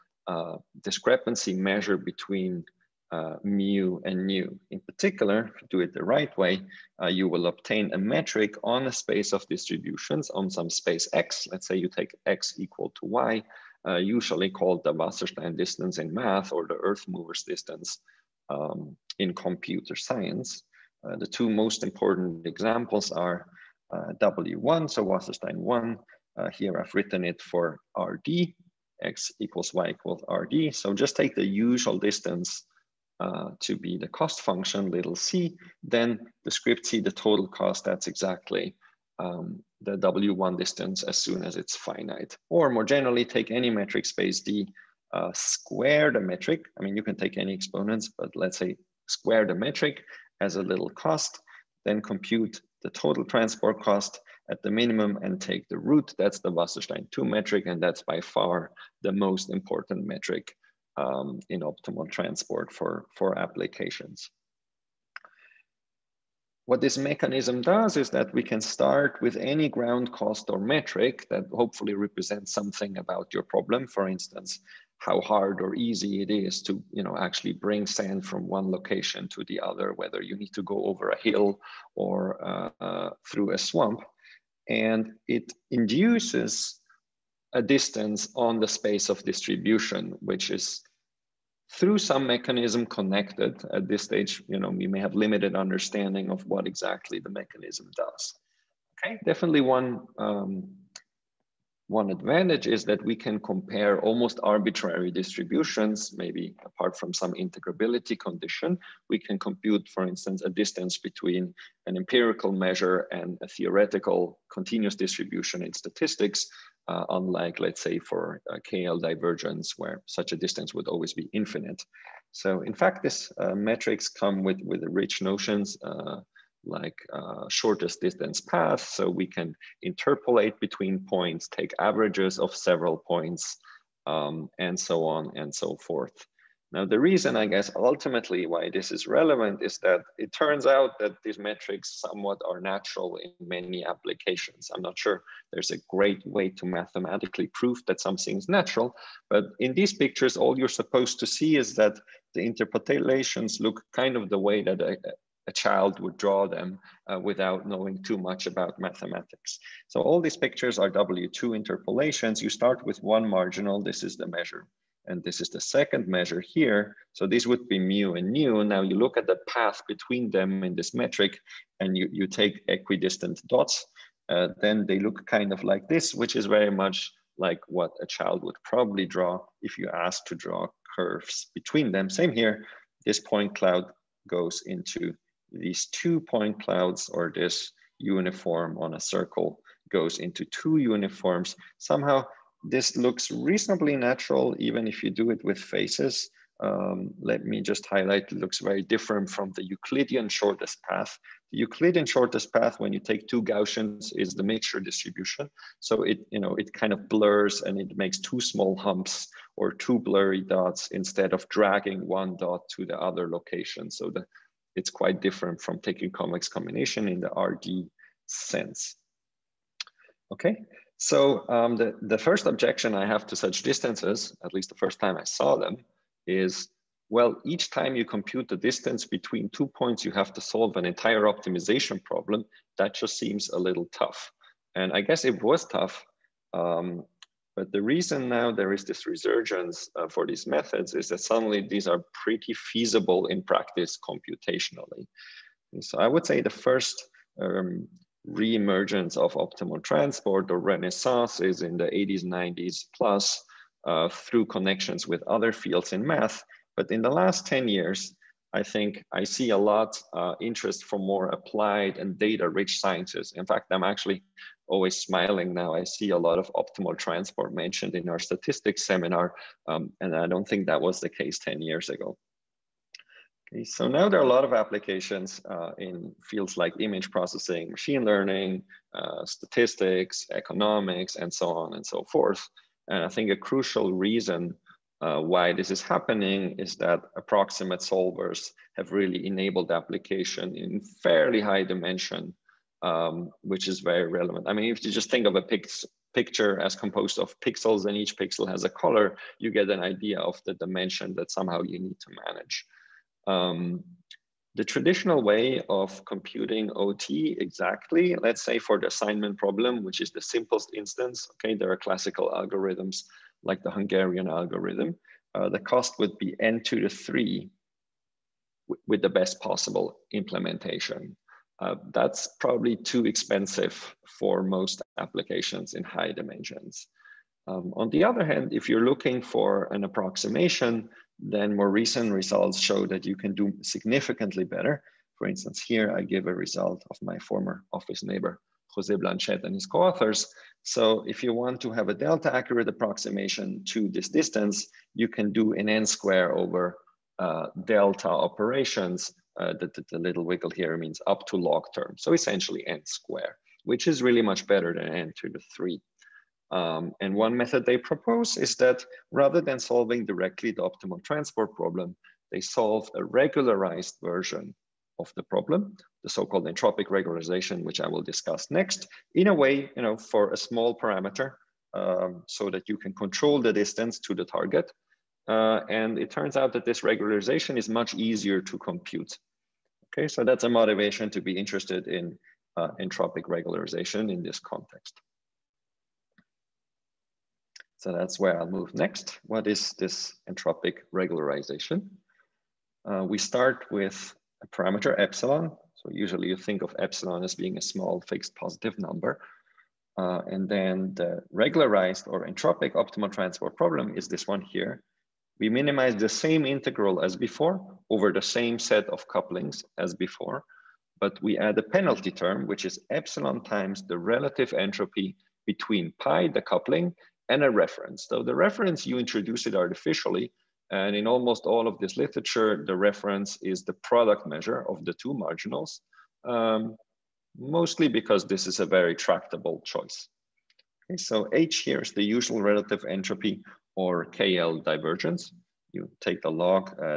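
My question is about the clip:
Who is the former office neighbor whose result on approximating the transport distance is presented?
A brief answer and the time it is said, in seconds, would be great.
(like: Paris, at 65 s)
Jose Blanchet, at 338 s.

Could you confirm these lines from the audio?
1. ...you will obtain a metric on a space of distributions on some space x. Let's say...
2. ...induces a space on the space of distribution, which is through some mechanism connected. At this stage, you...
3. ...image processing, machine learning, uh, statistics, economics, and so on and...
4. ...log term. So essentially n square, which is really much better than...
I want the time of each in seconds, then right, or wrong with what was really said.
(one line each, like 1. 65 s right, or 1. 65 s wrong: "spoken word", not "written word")
1. 7 s right
2. 85 s wrong: "distance", not "space"
3. 276 s right
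4. 351 s right.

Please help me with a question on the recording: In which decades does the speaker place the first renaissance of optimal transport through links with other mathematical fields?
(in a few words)
80s, 90s.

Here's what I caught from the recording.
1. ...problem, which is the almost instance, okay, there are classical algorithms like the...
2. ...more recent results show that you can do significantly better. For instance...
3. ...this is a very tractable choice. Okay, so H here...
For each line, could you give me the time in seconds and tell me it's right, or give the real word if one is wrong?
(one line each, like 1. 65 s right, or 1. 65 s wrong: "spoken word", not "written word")
1. 309 s wrong: "simplest", not "almost"
2. 331 s right
3. 428 s right.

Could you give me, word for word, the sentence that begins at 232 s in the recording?
That just seems a little tough.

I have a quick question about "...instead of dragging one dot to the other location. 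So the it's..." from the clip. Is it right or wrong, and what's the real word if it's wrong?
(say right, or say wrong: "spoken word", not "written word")
right.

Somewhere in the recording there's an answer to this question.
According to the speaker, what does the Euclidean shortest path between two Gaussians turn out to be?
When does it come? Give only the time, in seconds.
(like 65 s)
204 s.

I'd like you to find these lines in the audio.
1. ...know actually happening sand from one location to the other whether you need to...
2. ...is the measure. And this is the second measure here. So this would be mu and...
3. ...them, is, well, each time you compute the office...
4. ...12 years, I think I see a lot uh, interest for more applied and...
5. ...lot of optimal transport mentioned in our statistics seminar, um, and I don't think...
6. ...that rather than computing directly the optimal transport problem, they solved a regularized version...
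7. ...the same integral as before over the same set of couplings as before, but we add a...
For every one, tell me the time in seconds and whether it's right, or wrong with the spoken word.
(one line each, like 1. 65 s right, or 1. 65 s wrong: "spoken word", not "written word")
1. 77 s wrong: "bring", not "happening"
2. 164 s right
3. 225 s wrong: "distance", not "office"
4. 257 s wrong: "10", not "12"
5. 266 s right
6. 358 s wrong: "solving", not "computing"
7. 405 s right.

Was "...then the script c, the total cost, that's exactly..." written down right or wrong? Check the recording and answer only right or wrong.
right.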